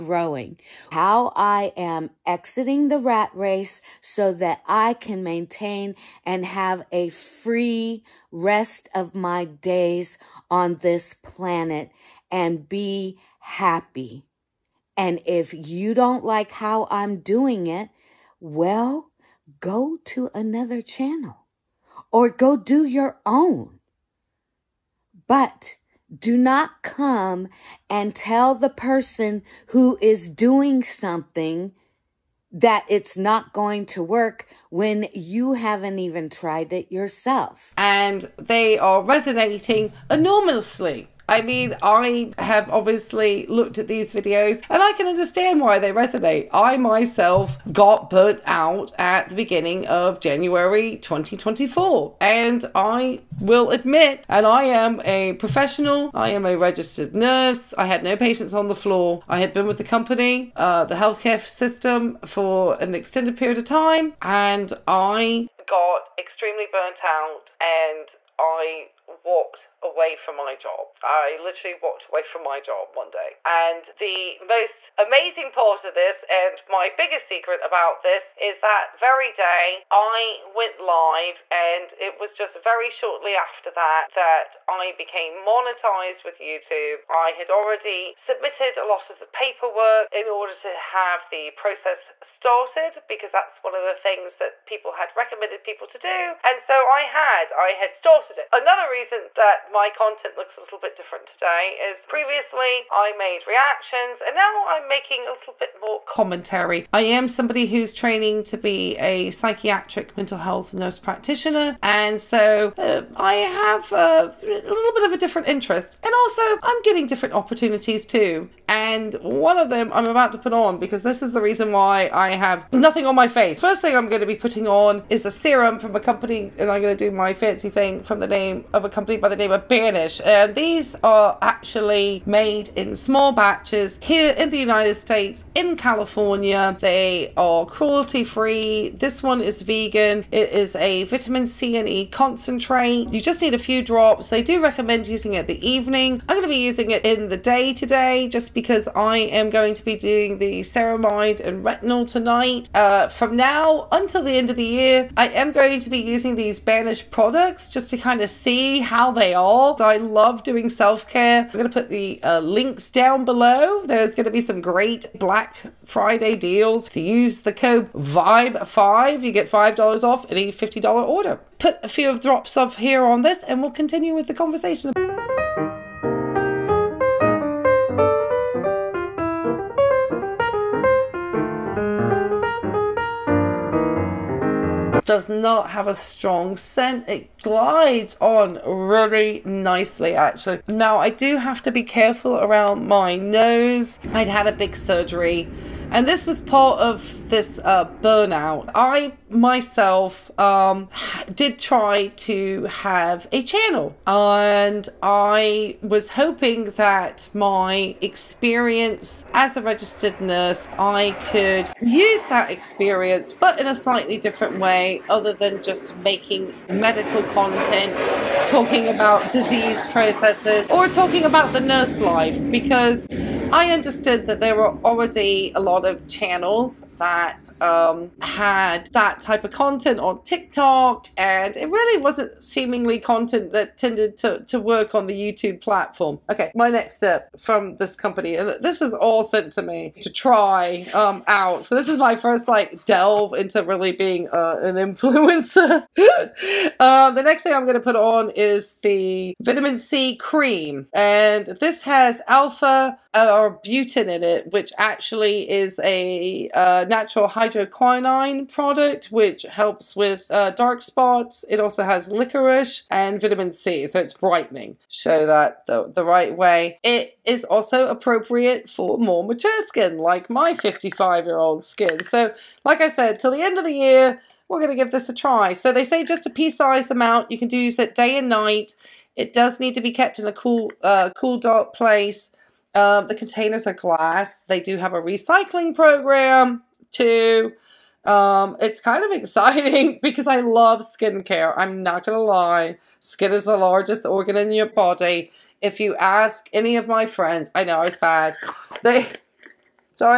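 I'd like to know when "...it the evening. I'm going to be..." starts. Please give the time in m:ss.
2:25.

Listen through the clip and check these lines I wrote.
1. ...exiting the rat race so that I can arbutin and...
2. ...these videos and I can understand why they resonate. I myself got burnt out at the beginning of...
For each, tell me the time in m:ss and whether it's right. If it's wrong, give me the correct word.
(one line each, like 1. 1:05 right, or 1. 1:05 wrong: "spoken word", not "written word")
1. 0:02 wrong: "maintain", not "arbutin"
2. 0:43 right.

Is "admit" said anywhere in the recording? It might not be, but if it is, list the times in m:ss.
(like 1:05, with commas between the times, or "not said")
0:53.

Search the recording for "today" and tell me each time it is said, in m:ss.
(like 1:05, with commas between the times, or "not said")
1:41, 2:27.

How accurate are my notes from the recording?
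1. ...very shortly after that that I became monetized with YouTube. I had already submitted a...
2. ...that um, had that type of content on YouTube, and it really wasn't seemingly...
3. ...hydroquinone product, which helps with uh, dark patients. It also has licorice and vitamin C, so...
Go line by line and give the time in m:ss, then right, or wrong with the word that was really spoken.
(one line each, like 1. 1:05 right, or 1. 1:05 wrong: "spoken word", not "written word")
1. 1:22 right
2. 3:46 wrong: "TikTok", not "YouTube"
3. 4:17 wrong: "spots", not "patients".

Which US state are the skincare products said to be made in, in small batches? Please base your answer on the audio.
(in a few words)
California.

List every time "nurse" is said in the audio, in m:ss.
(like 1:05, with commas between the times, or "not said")
0:57, 1:50, 3:30, 3:41.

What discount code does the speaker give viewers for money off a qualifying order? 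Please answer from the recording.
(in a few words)
VIBE5.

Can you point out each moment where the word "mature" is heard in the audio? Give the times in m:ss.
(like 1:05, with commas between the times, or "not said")
4:29.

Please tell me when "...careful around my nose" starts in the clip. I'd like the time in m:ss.
3:11.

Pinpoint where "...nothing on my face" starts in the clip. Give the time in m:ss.
2:02.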